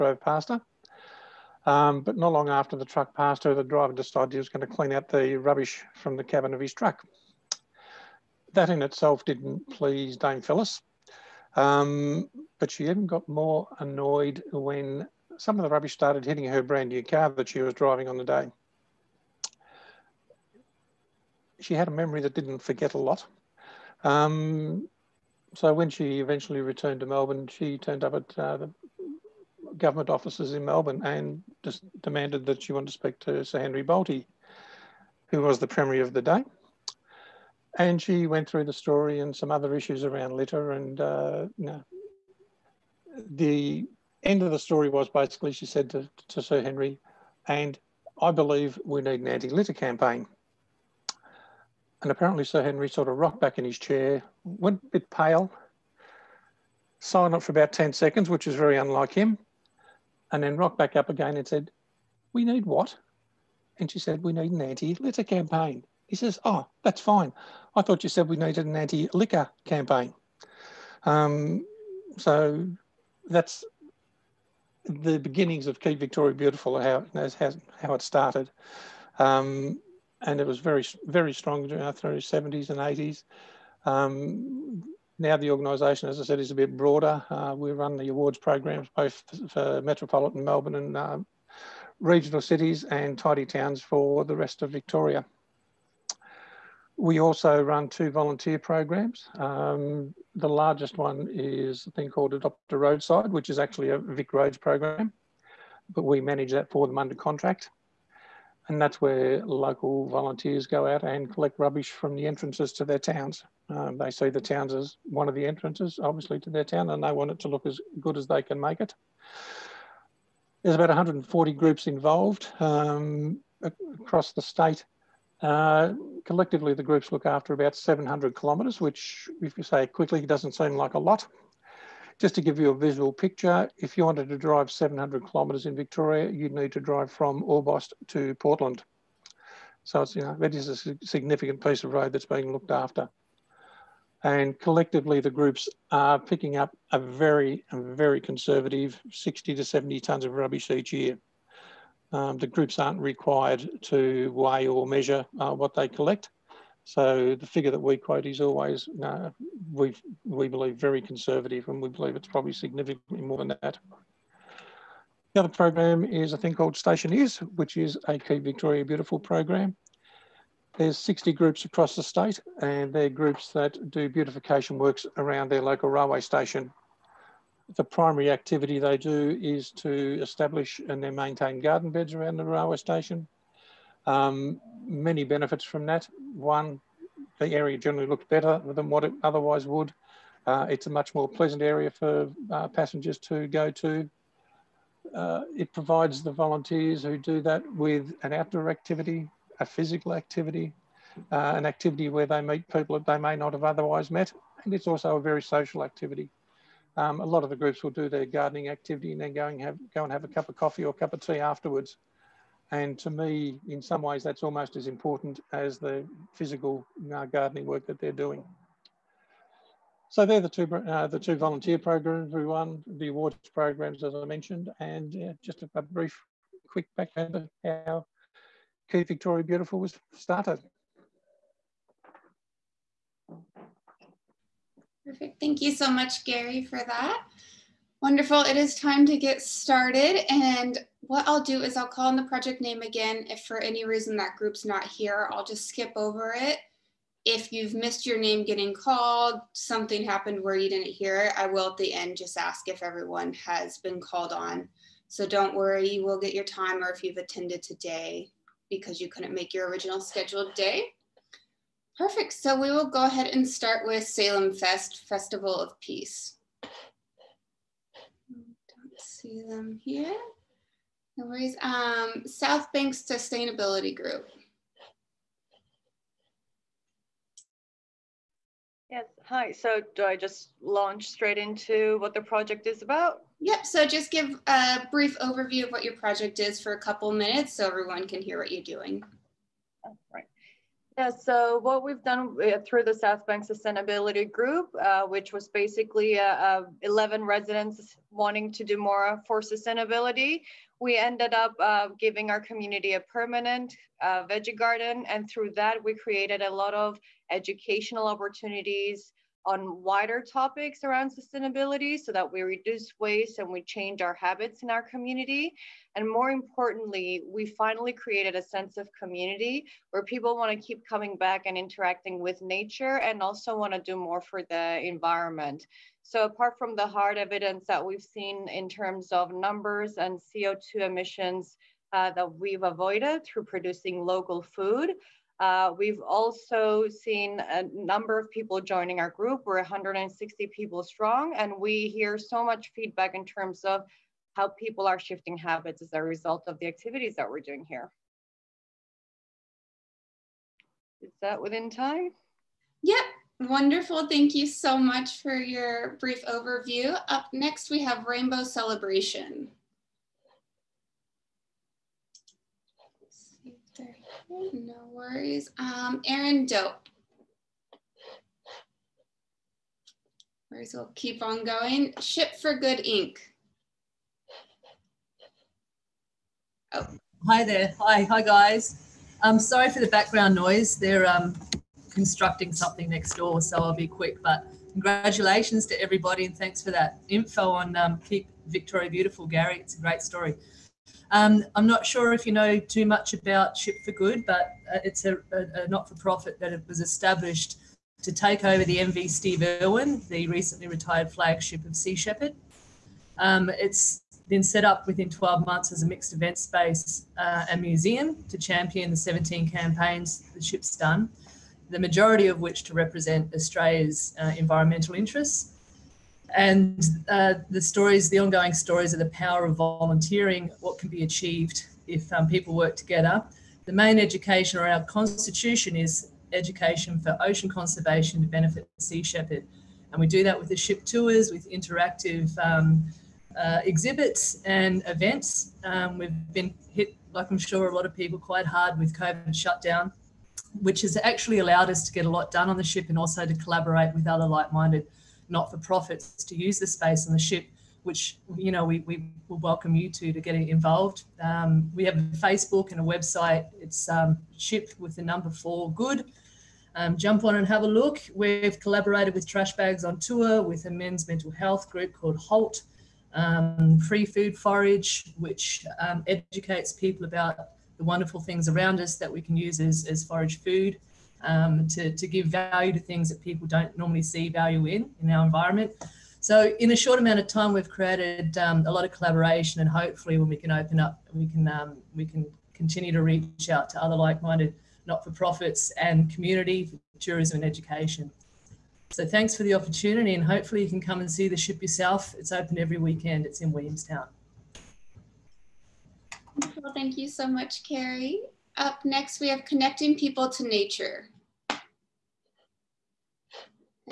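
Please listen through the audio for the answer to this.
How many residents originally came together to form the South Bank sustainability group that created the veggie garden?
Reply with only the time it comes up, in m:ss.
4:56.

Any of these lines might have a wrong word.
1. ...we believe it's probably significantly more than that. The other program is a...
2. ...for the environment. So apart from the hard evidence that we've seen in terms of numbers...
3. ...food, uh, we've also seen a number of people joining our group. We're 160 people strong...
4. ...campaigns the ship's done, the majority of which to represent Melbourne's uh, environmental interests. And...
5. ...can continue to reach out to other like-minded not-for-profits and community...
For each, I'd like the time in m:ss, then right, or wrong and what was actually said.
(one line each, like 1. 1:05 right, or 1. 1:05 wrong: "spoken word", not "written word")
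1. 2:41 right
2. 5:24 right
3. 5:34 right
4. 6:49 wrong: "Australia", not "Melbourne"
5. 8:02 right.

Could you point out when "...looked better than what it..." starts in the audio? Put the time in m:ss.
3:08.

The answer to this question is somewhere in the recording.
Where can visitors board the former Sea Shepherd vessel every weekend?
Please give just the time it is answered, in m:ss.
8:13.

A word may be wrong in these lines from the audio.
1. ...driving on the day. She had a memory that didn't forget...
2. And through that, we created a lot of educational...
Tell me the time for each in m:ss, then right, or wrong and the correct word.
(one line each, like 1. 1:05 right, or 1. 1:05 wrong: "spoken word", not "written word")
1. 0:17 right
2. 5:05 right.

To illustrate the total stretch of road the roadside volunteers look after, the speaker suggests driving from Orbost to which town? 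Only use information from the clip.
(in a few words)
Portland.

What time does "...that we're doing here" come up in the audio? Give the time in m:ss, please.
5:47.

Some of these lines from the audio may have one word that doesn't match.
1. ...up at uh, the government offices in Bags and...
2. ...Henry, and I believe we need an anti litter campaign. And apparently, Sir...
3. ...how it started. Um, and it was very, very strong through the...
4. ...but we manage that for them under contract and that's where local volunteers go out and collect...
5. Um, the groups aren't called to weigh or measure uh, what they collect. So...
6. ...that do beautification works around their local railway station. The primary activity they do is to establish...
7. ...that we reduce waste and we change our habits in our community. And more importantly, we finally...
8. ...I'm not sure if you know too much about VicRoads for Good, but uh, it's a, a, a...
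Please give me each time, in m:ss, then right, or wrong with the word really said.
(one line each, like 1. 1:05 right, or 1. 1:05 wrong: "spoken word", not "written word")
1. 0:28 wrong: "Melbourne", not "Bags"
2. 0:46 right
3. 1:17 right
4. 1:45 right
5. 2:32 wrong: "required", not "called"
6. 2:53 right
7. 5:12 right
8. 6:31 wrong: "Ship", not "VicRoads".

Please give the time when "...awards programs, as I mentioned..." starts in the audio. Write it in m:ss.
3:43.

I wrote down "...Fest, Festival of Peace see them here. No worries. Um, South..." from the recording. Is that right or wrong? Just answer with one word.
right.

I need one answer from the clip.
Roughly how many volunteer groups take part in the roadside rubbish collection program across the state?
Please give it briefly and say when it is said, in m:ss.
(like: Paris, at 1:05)
140, at 2:00.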